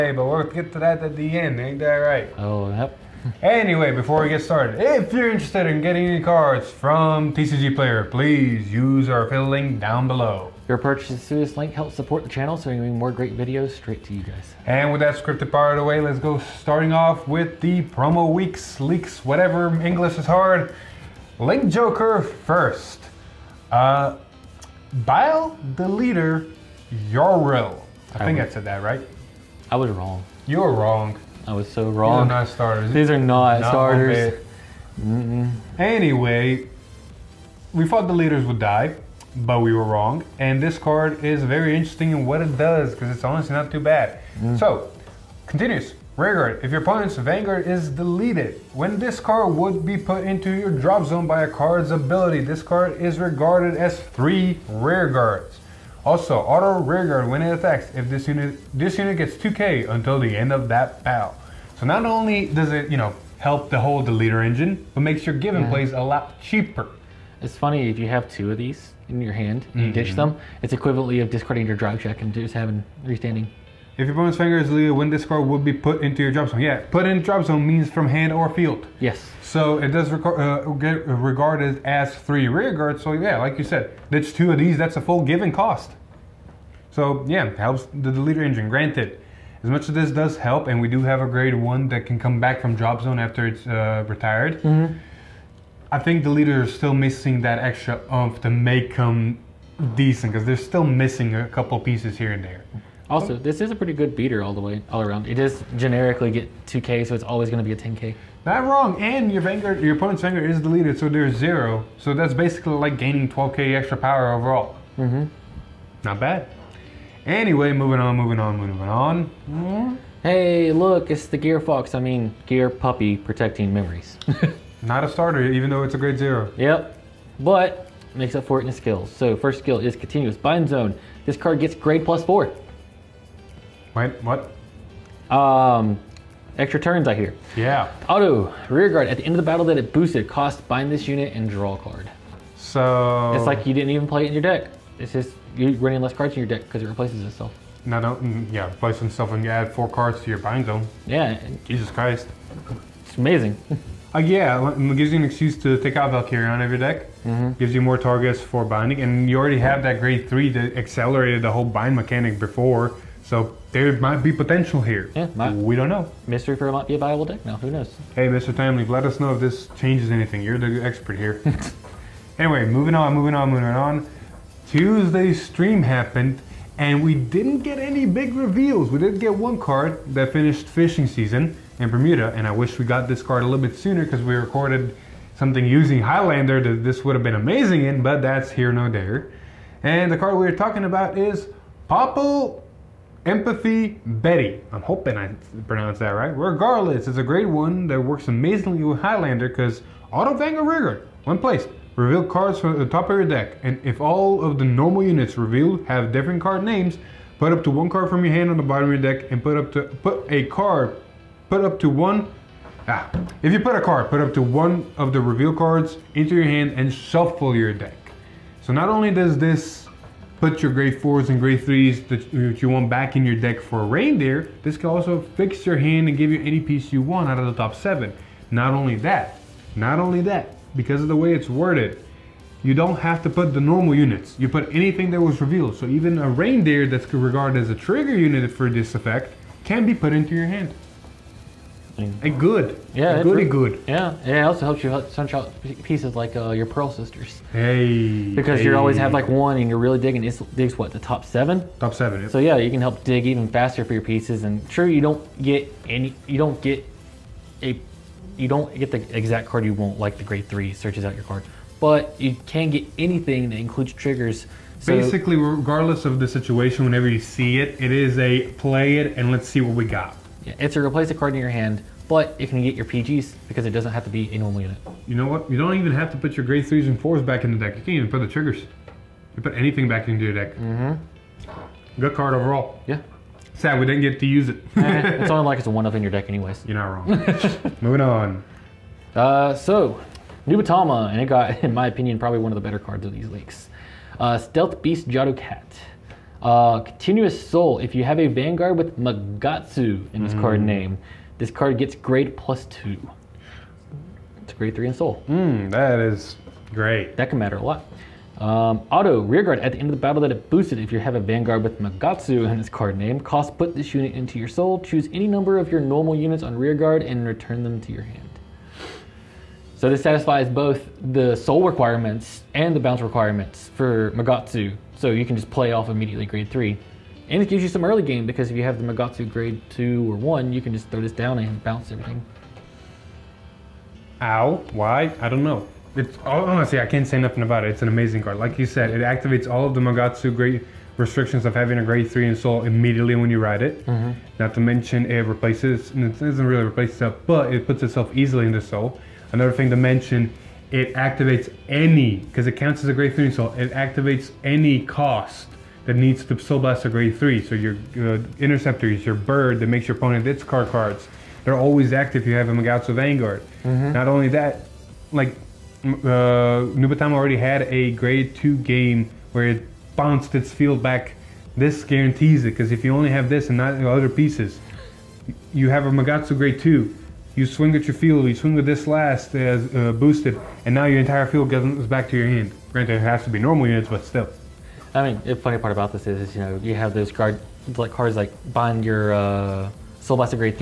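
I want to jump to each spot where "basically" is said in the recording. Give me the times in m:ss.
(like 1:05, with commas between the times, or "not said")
1:52, 4:24.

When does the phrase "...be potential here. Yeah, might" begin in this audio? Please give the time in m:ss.
2:44.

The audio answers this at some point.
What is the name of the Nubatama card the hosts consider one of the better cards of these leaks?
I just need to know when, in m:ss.
4:54.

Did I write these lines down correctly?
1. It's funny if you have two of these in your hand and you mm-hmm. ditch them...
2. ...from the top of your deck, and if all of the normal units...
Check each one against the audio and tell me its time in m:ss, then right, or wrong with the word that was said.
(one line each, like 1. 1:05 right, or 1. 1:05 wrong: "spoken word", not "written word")
1. 1:07 right
2. 3:22 right.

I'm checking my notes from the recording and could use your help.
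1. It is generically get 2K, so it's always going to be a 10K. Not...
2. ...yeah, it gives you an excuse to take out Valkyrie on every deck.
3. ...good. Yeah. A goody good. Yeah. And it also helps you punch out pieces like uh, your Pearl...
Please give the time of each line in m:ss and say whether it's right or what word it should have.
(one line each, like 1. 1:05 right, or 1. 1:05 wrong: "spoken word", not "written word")
1. 1:45 right
2. 2:34 right
3. 4:02 right.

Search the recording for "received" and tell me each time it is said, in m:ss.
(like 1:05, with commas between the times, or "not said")
not said.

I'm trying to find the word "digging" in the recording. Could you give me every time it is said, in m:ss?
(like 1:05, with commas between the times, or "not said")
4:09.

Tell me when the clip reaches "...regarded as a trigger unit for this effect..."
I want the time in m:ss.
3:57.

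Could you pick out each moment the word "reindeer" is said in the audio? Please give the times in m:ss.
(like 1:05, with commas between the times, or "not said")
3:43, 3:56.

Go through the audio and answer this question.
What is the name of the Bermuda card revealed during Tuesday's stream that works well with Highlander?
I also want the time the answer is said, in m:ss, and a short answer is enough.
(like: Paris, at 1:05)
Popple Empathy Betty, at 3:11.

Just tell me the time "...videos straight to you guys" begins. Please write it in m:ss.
0:13.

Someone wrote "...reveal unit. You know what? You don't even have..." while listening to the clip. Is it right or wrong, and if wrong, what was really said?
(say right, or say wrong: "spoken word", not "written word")
wrong: "normal", not "reveal".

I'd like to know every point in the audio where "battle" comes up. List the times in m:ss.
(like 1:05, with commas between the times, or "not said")
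1:01, 2:19, 5:10.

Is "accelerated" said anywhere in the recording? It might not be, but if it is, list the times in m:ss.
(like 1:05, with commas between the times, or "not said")
2:40.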